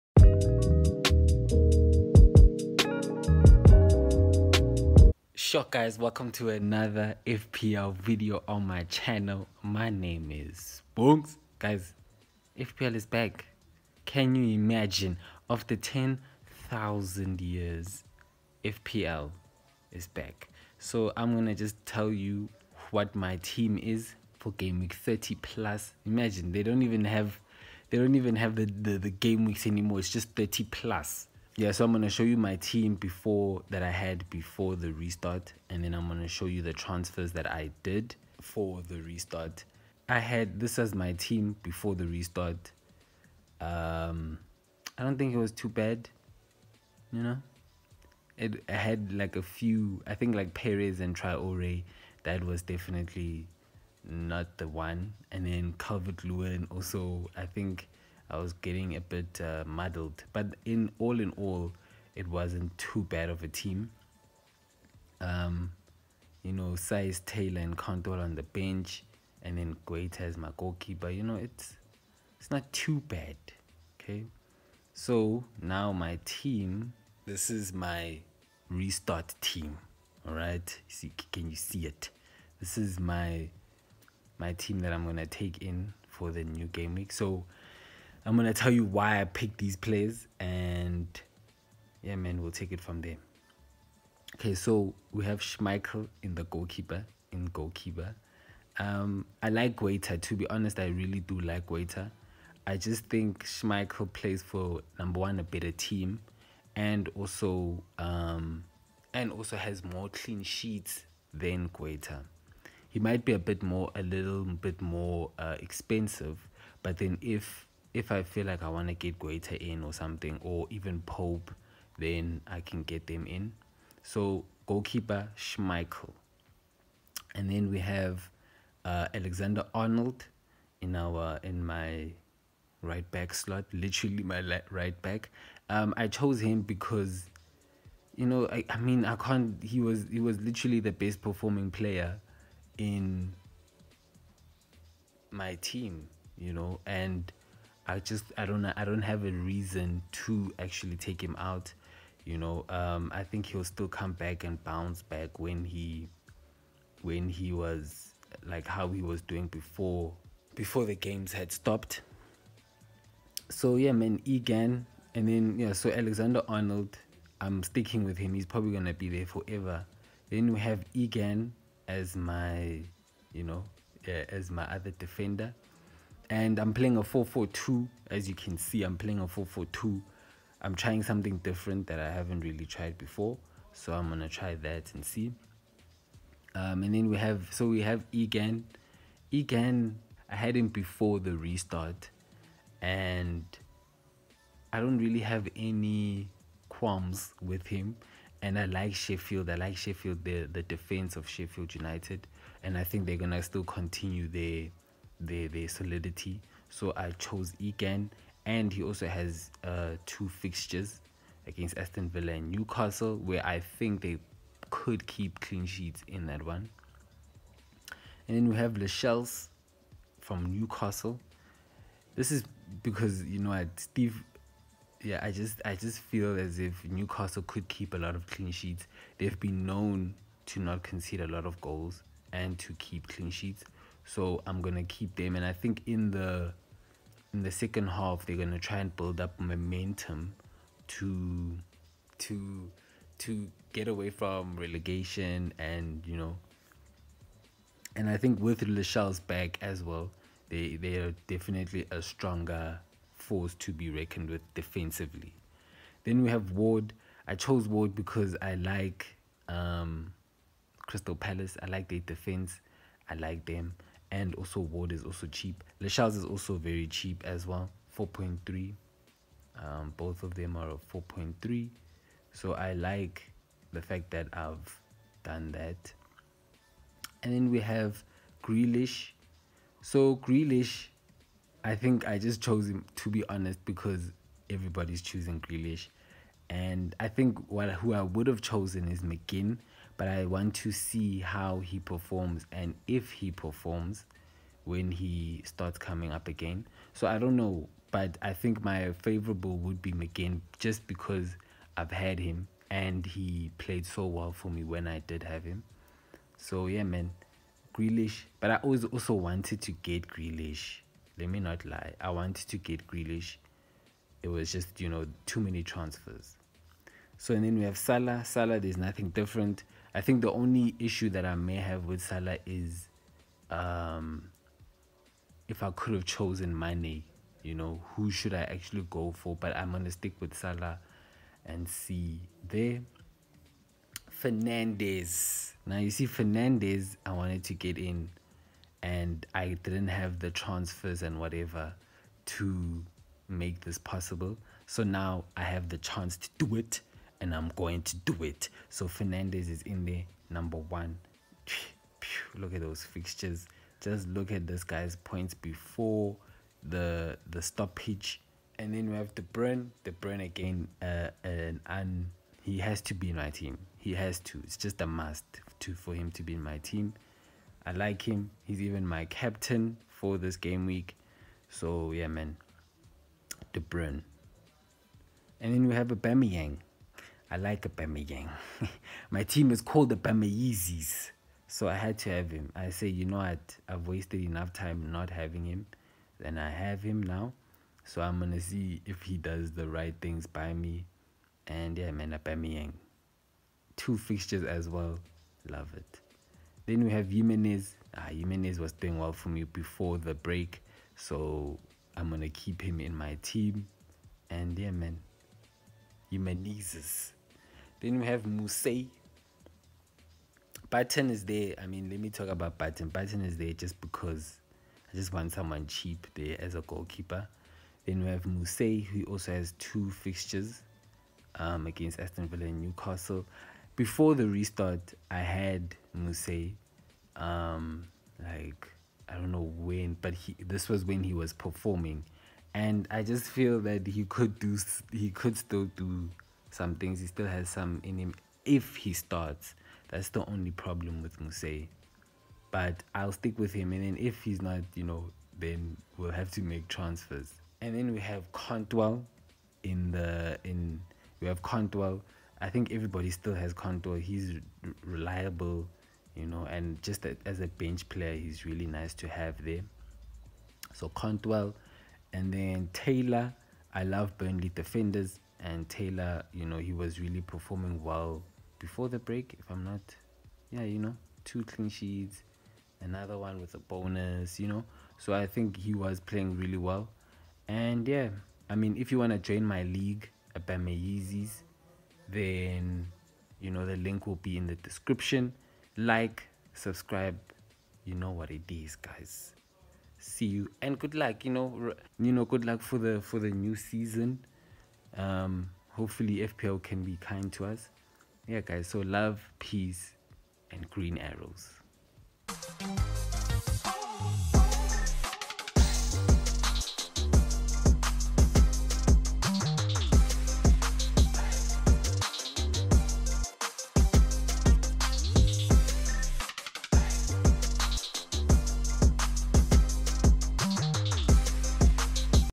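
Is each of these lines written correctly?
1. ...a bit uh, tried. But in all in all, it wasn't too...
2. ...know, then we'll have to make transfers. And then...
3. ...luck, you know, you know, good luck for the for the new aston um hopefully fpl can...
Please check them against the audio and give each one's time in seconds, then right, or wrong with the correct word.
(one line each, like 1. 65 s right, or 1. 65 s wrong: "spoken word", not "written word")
1. 58 s wrong: "muddled", not "tried"
2. 444 s right
3. 490 s wrong: "season", not "aston".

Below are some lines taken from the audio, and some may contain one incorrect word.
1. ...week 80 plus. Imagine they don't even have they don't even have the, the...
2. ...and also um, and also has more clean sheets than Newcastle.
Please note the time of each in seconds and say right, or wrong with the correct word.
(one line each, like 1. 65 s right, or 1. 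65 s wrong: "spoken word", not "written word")
1. 24 s wrong: "30", not "80"
2. 106 s wrong: "Guaita", not "Newcastle".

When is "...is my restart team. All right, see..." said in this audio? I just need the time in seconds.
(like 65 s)
77 s.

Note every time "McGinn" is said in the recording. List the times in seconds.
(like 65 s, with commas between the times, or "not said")
289 s, 299 s.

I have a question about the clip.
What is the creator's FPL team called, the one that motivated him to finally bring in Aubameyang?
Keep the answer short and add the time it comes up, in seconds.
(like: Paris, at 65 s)
the Yeezys, at 379 s.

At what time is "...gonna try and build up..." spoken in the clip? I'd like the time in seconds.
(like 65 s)
238 s.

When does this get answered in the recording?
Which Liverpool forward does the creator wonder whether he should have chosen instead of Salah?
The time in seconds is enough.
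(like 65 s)
326 s.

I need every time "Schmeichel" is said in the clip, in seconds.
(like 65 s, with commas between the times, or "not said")
95 s, 103 s, 125 s.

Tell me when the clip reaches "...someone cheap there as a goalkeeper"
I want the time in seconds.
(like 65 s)
415 s.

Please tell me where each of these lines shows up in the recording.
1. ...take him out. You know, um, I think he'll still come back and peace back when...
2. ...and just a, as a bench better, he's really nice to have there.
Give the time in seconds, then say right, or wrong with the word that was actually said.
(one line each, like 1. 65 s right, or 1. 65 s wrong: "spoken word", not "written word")
1. 150 s wrong: "bounce", not "peace"
2. 456 s wrong: "player", not "better".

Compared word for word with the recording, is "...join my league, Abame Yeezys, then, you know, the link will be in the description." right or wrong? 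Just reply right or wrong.
right.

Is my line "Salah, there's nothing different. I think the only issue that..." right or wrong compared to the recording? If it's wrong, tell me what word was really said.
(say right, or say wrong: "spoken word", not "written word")
right.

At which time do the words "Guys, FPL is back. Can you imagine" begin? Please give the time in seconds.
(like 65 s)
11 s.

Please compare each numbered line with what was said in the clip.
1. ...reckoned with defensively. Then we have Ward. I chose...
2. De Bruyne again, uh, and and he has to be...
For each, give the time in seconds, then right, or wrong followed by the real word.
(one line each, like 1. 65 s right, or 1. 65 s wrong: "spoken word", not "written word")
1. 253 s right
2. 359 s right.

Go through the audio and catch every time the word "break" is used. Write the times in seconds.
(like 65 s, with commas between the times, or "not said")
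400 s, 468 s.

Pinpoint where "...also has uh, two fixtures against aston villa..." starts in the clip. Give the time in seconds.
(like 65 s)
208 s.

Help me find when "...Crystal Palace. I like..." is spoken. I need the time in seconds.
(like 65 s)
260 s.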